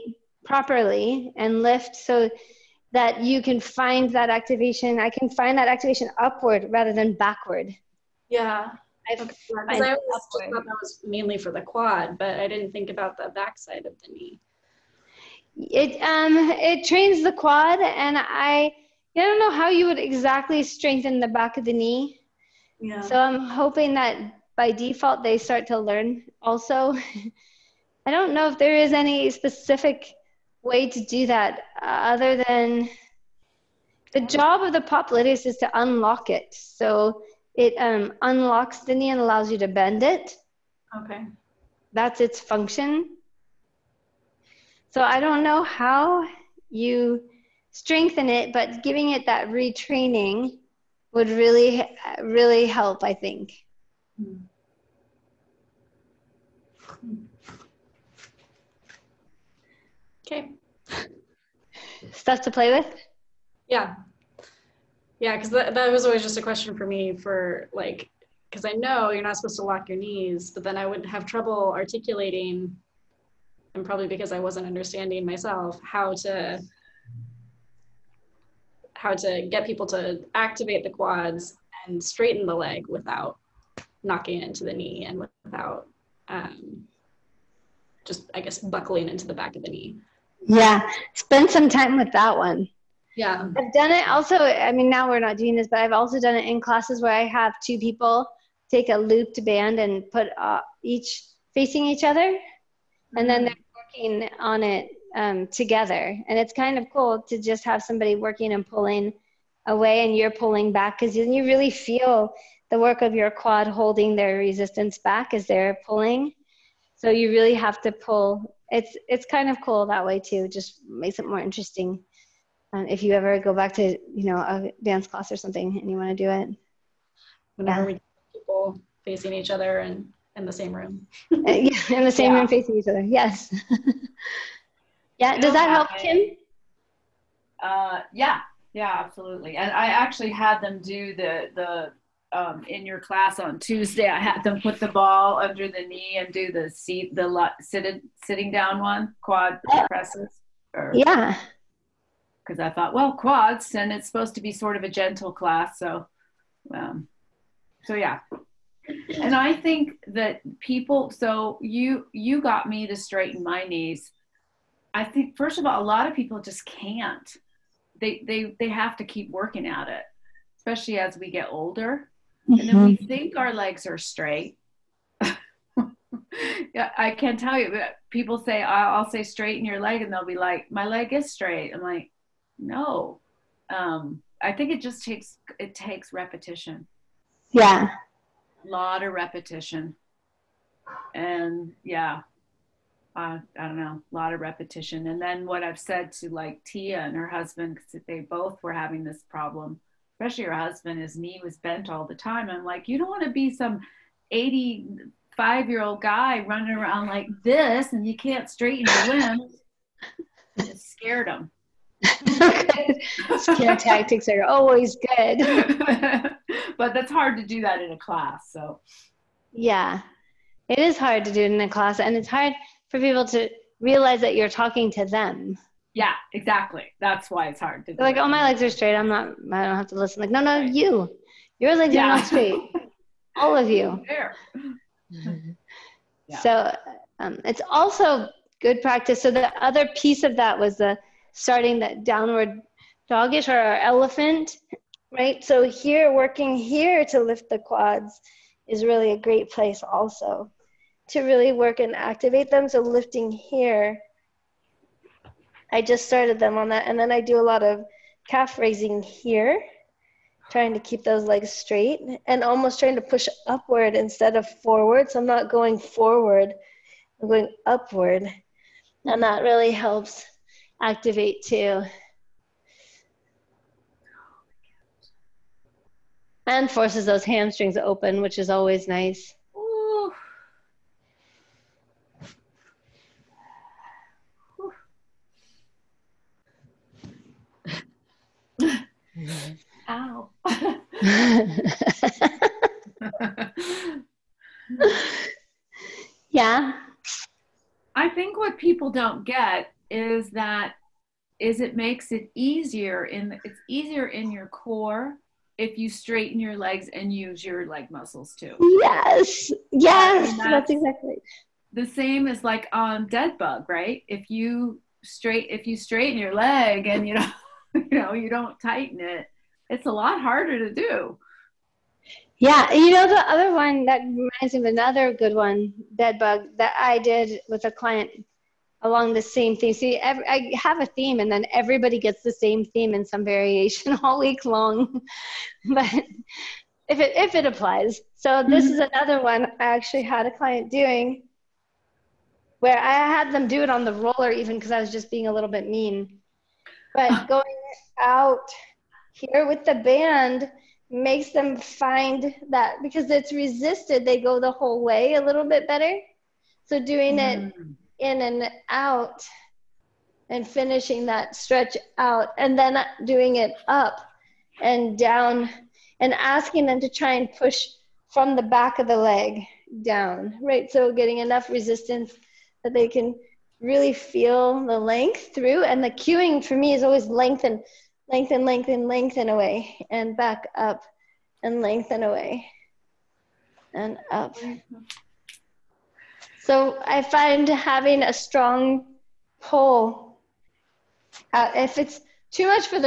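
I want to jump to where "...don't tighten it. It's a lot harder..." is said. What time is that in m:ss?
5:18.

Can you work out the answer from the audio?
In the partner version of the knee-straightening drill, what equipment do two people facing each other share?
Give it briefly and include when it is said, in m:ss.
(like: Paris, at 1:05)
looped band, at 1:38.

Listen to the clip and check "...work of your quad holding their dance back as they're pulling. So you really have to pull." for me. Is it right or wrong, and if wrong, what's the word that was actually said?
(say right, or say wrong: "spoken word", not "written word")
wrong: "resistance", not "dance".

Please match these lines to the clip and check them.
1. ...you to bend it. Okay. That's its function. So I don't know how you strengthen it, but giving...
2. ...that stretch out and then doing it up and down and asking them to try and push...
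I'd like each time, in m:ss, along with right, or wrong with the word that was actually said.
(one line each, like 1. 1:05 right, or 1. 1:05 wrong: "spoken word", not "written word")
1. 0:39 right
2. 6:01 right.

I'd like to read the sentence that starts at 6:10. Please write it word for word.
So getting enough resistance that they can really feel the length through.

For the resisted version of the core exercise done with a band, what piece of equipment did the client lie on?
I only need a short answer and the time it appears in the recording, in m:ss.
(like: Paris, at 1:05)
roller, at 5:43.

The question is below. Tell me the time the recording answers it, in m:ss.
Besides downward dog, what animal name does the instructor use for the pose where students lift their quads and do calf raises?
4:03.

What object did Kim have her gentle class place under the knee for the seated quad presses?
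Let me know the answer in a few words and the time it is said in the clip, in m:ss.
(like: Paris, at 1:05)
ball, at 2:24.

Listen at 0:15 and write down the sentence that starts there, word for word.
It um it trains the quad, and I I don't know how you would exactly strengthen the back of the knee.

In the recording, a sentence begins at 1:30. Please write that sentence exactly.
Yeah, spend some time with that one.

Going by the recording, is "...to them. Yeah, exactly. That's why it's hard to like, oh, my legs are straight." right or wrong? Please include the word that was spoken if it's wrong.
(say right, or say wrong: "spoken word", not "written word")
right.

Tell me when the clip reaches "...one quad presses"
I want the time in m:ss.
2:28.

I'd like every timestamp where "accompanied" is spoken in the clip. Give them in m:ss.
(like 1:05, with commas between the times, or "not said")
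not said.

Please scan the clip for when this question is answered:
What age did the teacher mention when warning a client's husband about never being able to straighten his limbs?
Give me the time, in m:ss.
3:24.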